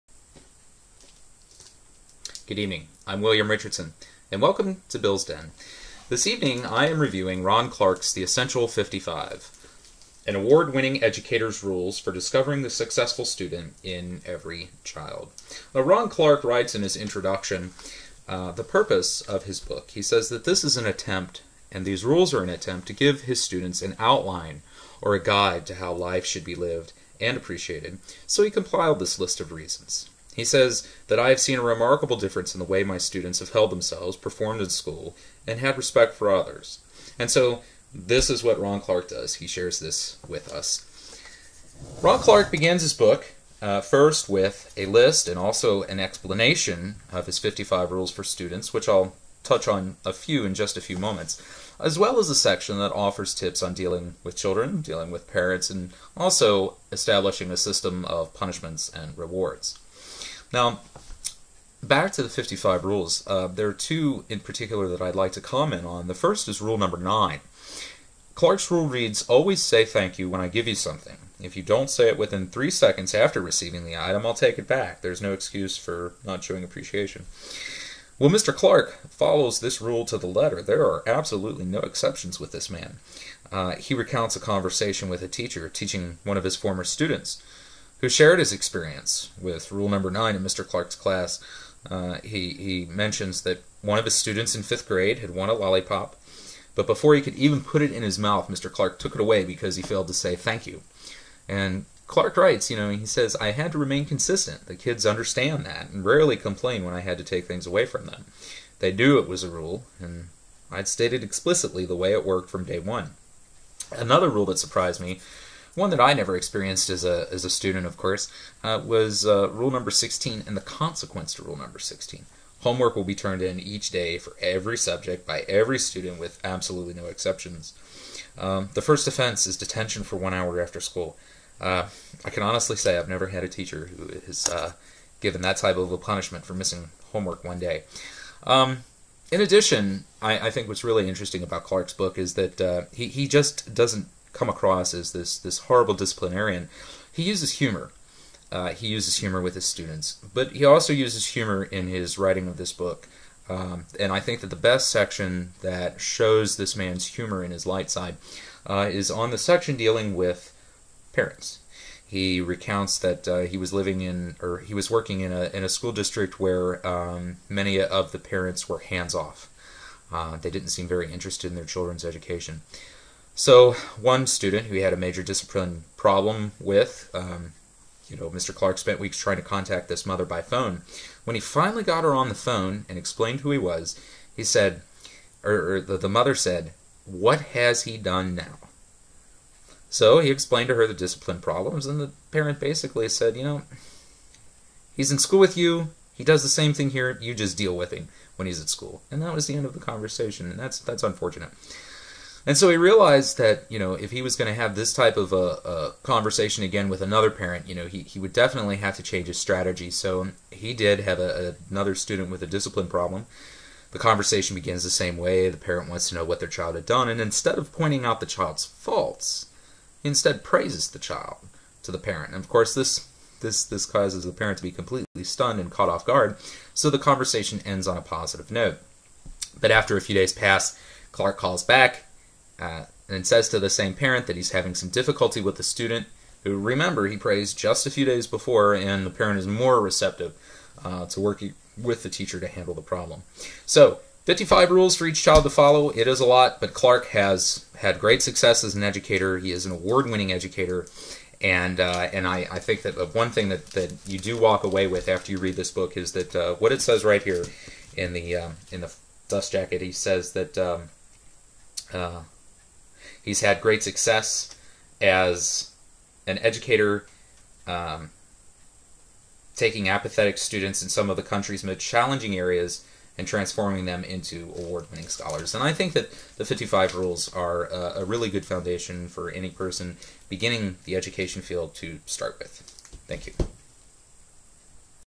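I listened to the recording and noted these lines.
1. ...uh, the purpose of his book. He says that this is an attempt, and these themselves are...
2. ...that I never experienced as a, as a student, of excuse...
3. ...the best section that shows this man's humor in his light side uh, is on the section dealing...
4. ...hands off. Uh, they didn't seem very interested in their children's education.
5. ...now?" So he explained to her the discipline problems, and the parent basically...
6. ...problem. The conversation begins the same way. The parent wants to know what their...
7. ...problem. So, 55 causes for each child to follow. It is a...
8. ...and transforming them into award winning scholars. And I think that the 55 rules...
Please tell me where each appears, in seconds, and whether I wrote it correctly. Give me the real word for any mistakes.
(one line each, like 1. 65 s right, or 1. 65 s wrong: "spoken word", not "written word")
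1. 18 s wrong: "rules", not "themselves"
2. 115 s wrong: "course", not "excuse"
3. 154 s right
4. 168 s right
5. 188 s right
6. 212 s right
7. 242 s wrong: "rules", not "causes"
8. 273 s right.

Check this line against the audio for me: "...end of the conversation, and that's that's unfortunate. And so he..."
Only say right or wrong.
right.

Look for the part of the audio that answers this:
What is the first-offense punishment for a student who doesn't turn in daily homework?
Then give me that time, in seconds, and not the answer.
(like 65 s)
129 s.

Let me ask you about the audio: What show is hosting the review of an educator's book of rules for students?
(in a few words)
Bill's Den.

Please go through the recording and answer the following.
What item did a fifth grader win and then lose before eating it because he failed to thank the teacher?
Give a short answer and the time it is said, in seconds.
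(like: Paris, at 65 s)
a lollipop, at 95 s.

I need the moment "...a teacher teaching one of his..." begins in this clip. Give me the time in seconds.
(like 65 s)
85 s.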